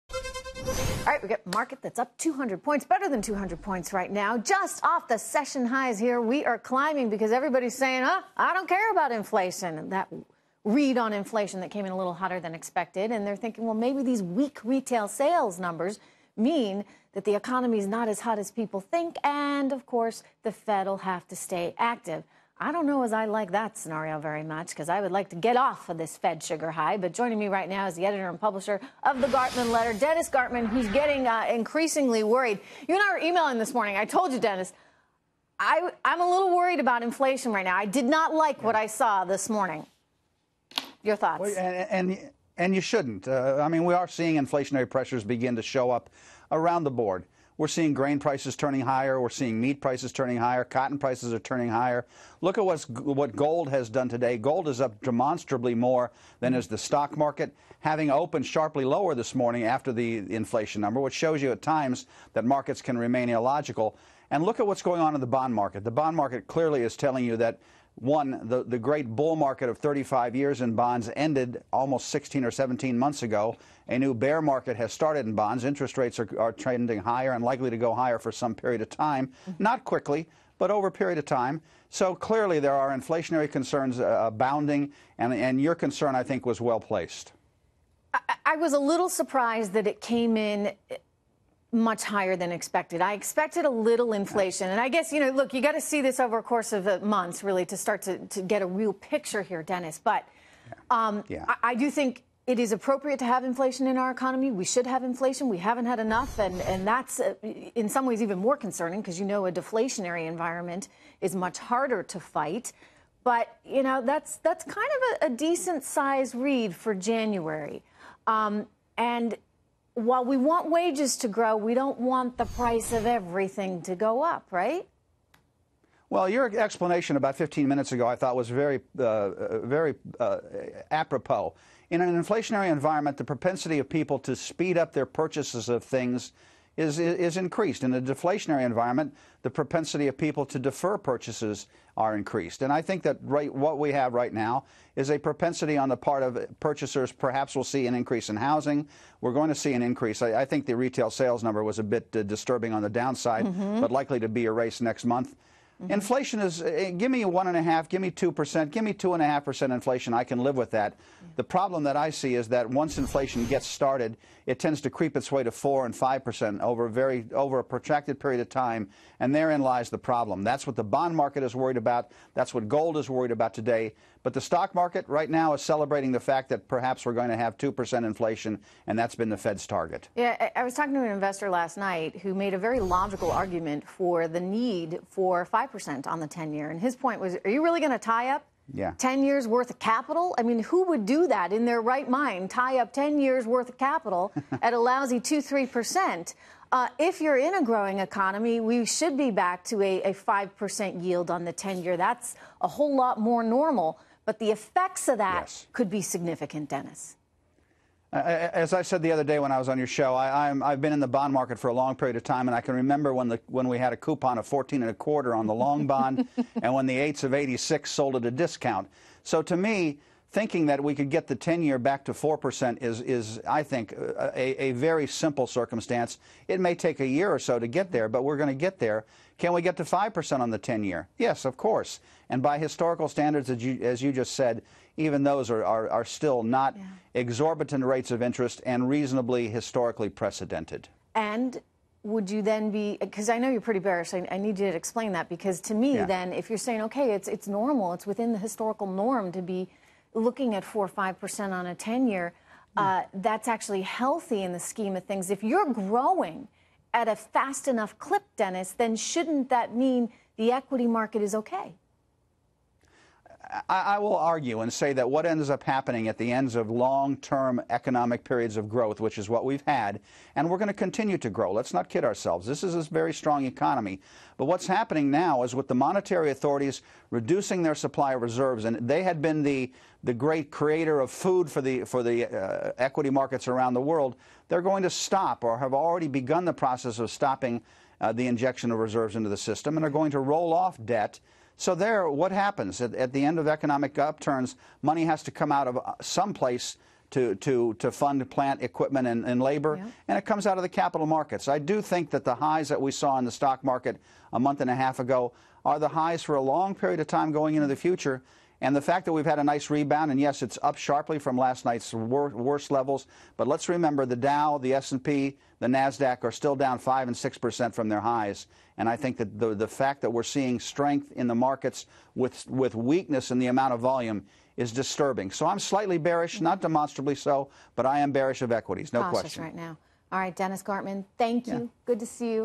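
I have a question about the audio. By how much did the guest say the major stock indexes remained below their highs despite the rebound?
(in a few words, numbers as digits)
5 and 6%.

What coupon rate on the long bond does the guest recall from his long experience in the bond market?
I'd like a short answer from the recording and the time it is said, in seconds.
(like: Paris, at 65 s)
14 and a quarter, at 214 s.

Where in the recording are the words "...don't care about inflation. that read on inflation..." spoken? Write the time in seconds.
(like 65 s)
8 s.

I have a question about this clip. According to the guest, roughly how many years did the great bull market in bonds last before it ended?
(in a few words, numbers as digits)
35 years.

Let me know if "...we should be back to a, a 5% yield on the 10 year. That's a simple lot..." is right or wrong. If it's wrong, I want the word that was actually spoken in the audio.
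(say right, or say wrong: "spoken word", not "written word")
wrong: "whole", not "simple".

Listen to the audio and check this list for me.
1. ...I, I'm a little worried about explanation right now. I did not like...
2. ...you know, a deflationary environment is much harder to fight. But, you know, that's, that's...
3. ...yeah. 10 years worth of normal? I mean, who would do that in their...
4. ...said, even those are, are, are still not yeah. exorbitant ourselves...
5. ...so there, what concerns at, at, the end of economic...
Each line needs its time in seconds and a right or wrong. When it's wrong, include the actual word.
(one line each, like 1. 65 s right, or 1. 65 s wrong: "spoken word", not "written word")
1. 35 s wrong: "inflation", not "explanation"
2. 109 s right
3. 188 s wrong: "capital", not "normal"
4. 234 s wrong: "rates", not "ourselves"
5. 291 s wrong: "happens", not "concerns".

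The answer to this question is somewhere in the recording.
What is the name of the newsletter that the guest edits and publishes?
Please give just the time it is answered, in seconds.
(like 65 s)
29 s.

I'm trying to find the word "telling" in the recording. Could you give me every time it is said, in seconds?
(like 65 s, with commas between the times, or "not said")
66 s.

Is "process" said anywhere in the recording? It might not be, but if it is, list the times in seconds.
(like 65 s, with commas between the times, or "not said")
286 s.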